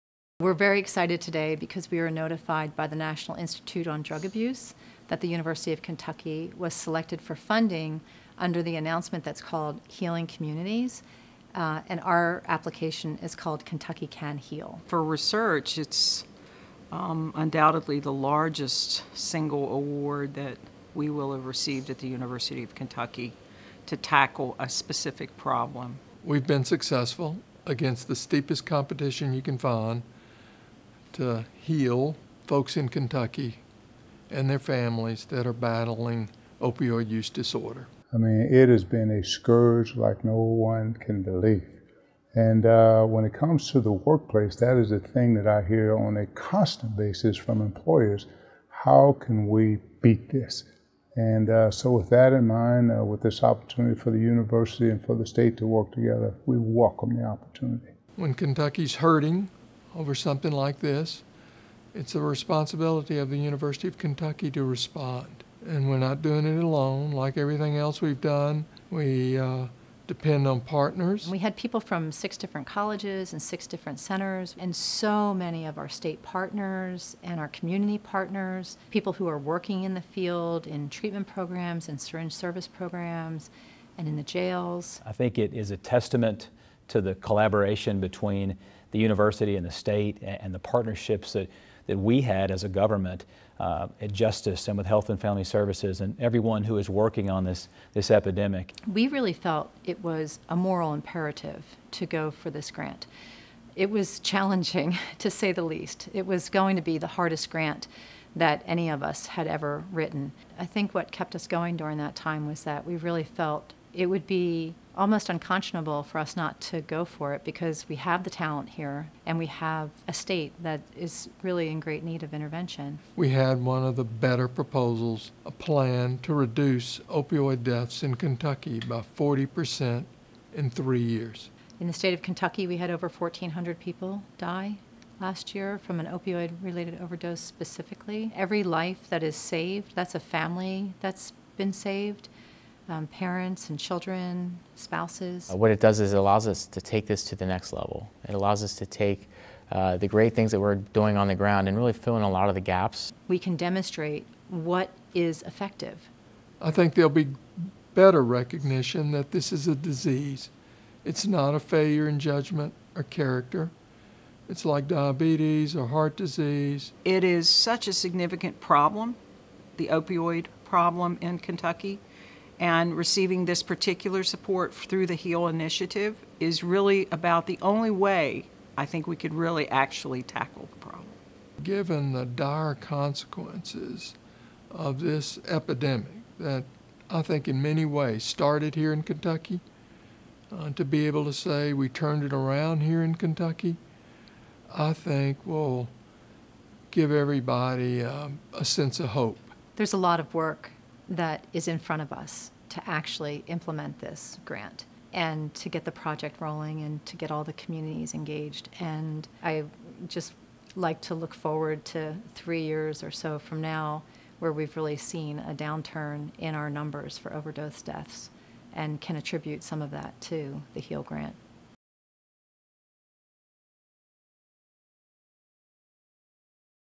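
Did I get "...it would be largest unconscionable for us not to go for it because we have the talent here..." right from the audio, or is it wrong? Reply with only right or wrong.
wrong.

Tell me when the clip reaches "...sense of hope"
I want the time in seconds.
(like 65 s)
198 s.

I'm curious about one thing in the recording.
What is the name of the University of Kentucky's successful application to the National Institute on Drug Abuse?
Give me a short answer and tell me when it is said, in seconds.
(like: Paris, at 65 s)
Kentucky Can Heal, at 13 s.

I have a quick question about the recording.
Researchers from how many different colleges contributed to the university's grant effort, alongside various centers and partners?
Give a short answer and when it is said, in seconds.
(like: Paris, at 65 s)
6, at 72 s.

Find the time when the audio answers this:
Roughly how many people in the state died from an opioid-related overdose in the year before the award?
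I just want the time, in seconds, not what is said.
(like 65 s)
132 s.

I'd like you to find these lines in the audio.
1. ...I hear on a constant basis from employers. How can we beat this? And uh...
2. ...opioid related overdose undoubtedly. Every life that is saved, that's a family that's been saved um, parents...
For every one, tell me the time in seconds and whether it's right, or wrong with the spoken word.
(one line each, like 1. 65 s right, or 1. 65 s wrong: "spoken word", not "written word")
1. 45 s right
2. 136 s wrong: "specifically", not "undoubtedly".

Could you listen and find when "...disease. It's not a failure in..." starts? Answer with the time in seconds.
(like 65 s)
159 s.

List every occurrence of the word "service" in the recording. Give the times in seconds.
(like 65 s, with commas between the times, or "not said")
82 s, 95 s.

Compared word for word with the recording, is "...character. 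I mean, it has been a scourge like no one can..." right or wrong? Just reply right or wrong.
wrong.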